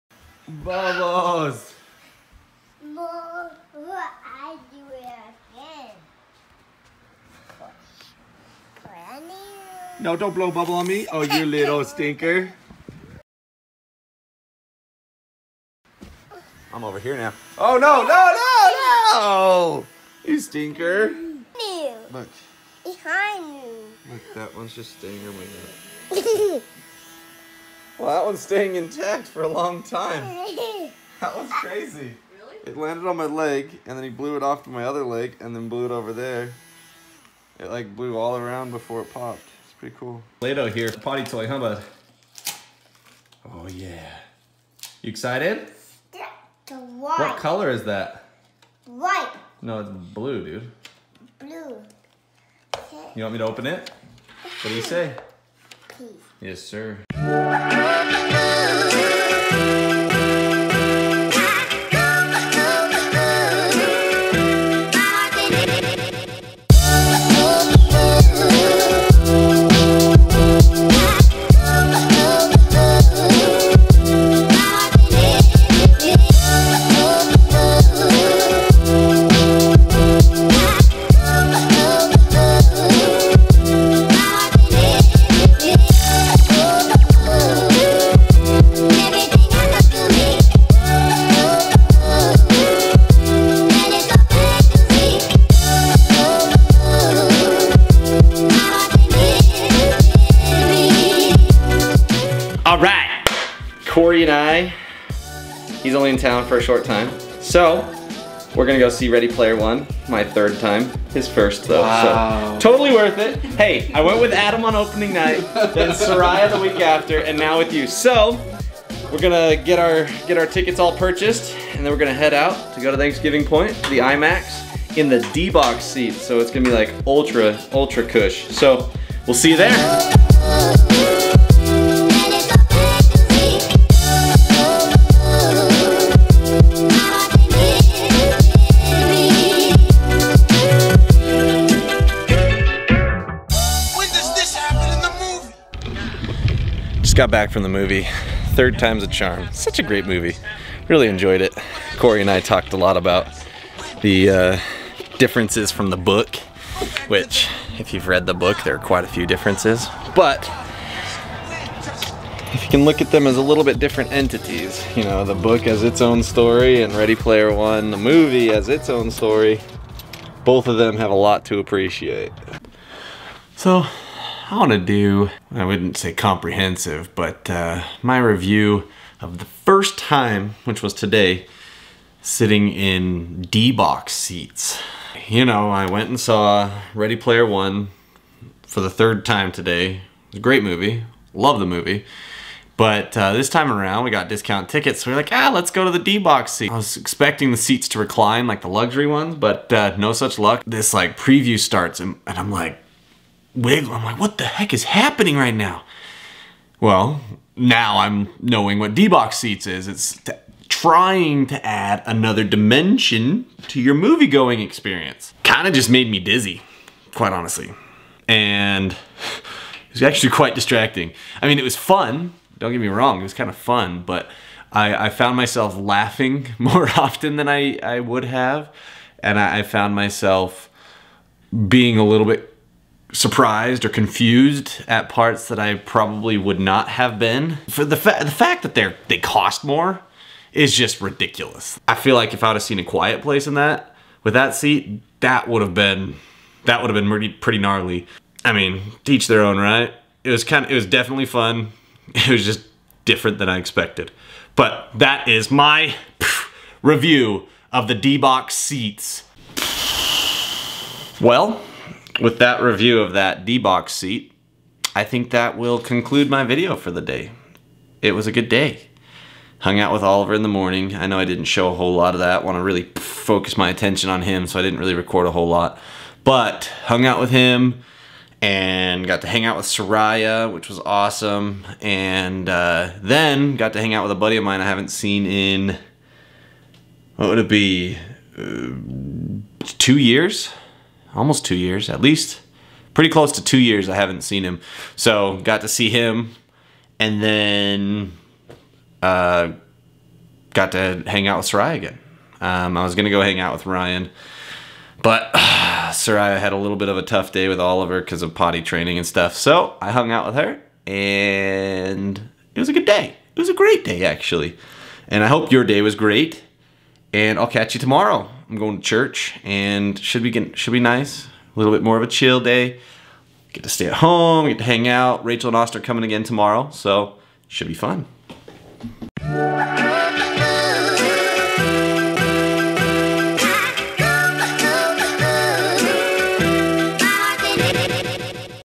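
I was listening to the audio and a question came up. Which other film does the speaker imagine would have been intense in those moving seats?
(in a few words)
A Quiet Place.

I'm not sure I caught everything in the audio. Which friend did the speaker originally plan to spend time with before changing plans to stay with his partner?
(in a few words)
Ryan.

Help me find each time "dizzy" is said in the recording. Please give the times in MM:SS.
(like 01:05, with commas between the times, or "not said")
03:36.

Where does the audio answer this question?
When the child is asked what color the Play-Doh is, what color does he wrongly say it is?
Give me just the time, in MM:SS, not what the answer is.
00:48.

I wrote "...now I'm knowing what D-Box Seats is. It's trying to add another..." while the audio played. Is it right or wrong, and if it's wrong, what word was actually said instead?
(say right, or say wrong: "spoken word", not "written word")
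right.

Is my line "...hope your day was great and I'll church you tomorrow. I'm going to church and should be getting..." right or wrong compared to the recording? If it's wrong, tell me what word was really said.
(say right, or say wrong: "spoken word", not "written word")
wrong: "catch", not "church".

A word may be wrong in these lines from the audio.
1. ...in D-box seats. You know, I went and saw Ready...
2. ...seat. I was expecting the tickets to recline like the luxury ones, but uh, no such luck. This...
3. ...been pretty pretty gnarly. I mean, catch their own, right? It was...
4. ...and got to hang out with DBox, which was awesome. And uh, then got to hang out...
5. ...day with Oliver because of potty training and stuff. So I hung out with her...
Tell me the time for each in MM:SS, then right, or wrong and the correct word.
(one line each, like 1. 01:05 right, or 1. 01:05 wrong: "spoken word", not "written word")
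1. 03:02 right
2. 03:16 wrong: "seats", not "tickets"
3. 04:06 wrong: "teach", not "catch"
4. 04:38 wrong: "Sariah", not "DBox"
5. 05:07 right.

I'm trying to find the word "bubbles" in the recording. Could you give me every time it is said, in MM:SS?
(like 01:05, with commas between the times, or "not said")
00:00, 00:10.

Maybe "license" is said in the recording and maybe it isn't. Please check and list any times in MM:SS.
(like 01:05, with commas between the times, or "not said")
not said.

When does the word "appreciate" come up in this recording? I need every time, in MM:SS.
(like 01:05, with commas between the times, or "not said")
02:51.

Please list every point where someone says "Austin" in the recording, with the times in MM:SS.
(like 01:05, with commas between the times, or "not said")
05:25.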